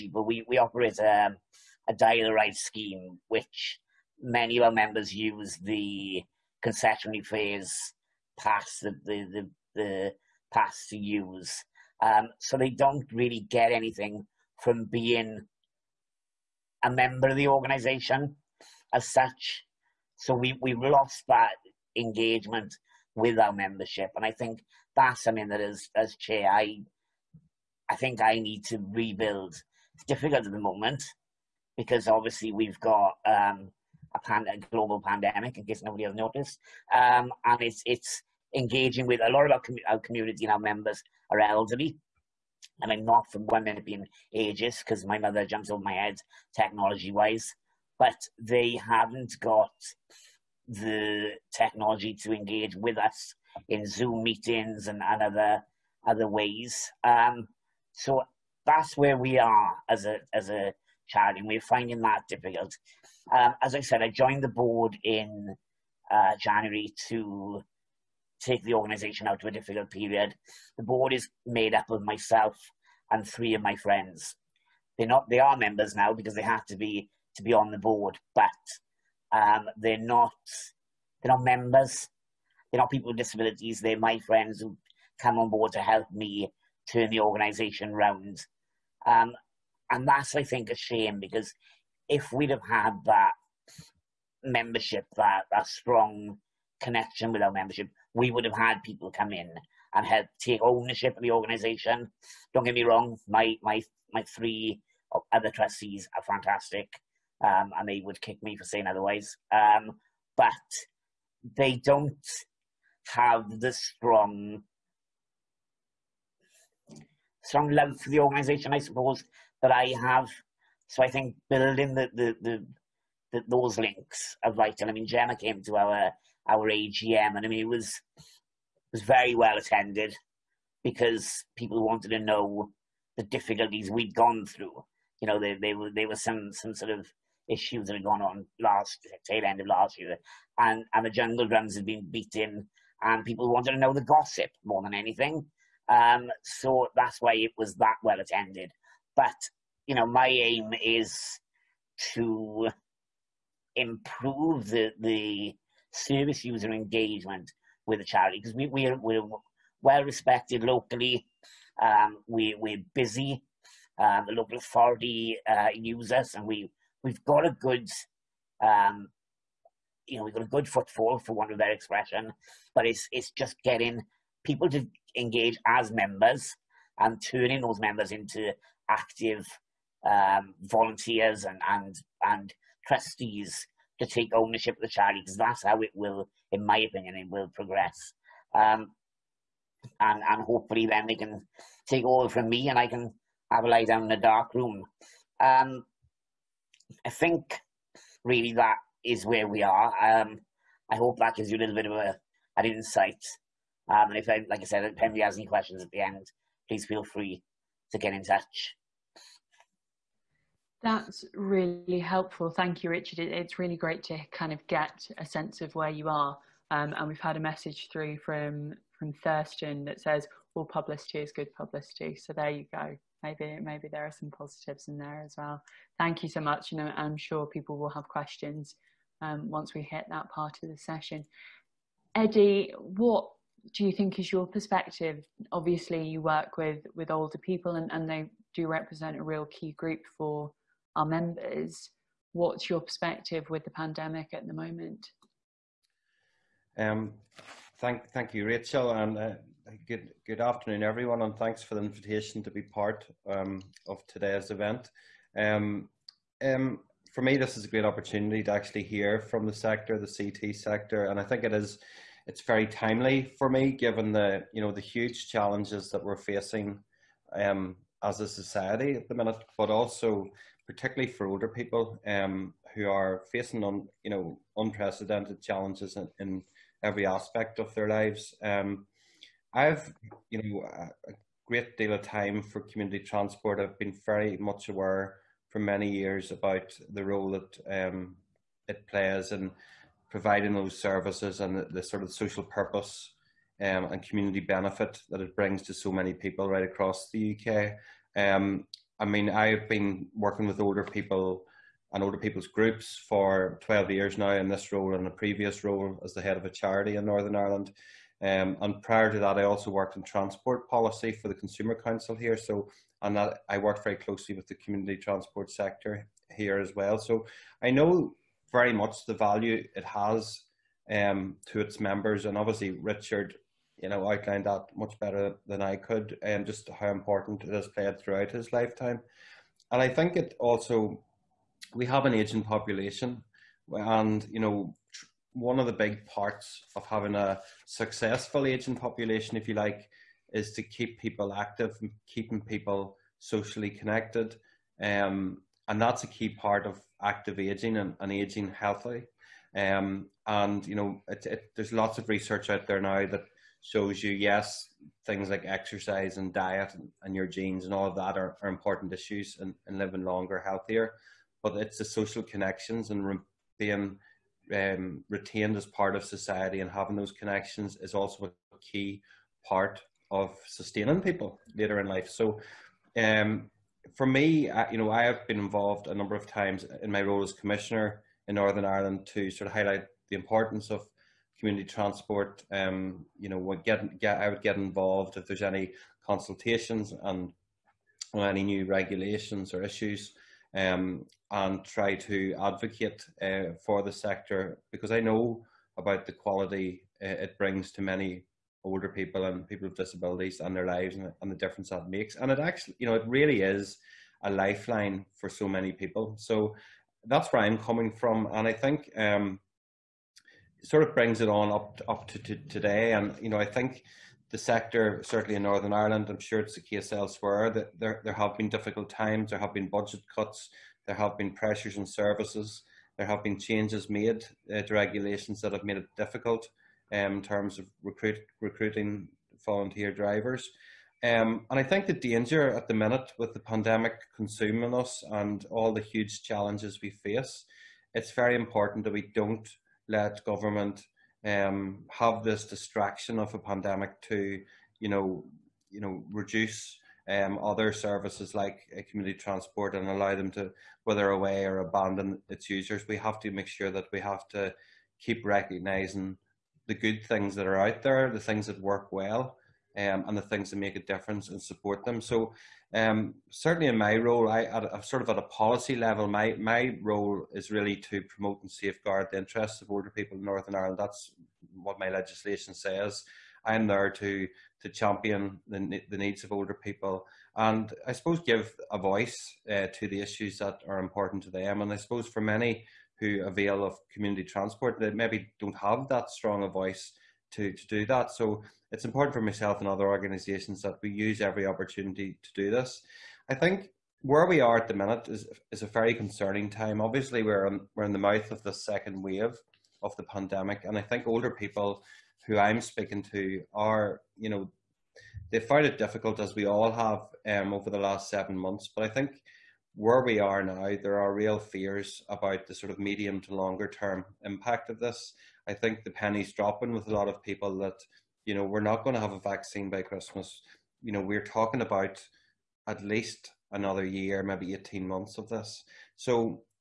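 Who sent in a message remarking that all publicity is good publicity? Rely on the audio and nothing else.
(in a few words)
Thurston.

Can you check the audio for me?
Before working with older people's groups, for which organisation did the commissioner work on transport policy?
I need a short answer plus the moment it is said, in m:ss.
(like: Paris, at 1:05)
Consumer Council, at 5:11.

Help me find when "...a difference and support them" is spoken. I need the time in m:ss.
7:40.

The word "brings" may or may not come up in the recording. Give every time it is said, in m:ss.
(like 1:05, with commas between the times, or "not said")
4:55, 6:37, 6:50.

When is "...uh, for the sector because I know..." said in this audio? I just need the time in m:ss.
6:33.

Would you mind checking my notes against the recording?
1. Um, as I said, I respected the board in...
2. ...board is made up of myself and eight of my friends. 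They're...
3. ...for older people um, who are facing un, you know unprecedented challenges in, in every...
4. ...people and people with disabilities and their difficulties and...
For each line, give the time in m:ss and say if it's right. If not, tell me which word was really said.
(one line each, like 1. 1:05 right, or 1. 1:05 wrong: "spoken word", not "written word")
1. 1:03 wrong: "joined", not "respected"
2. 1:10 wrong: "three", not "eight"
3. 4:31 right
4. 6:38 wrong: "lives", not "difficulties".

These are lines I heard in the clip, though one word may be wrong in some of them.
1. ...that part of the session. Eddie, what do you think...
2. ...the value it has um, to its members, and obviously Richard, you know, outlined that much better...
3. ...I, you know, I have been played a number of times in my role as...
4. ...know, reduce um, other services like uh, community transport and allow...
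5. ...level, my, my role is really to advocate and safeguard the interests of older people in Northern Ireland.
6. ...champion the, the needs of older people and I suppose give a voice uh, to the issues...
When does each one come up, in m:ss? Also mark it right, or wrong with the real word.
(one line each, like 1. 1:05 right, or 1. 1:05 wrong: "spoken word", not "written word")
1. 3:50 right
2. 5:19 right
3. 6:14 wrong: "involved", not "played"
4. 7:25 right
5. 7:45 wrong: "promote", not "advocate"
6. 7:54 right.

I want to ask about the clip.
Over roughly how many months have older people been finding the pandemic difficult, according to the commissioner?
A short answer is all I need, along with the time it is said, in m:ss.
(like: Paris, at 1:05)
7, at 8:28.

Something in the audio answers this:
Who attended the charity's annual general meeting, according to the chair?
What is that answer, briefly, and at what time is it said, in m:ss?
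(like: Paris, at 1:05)
Gemma, at 2:05.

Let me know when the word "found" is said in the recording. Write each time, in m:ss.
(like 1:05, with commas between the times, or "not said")
8:25.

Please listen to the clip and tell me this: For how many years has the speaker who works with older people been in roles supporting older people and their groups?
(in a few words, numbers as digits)
12.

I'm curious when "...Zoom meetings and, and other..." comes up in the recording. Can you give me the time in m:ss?
0:53.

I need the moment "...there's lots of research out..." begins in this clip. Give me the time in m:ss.
5:51.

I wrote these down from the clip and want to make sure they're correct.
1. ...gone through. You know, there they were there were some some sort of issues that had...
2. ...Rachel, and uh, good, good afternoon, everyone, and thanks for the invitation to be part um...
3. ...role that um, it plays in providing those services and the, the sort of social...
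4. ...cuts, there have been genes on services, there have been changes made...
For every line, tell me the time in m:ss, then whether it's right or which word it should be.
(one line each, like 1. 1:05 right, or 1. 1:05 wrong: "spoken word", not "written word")
1. 2:14 right
2. 4:08 right
3. 4:47 right
4. 7:00 wrong: "pressures", not "genes".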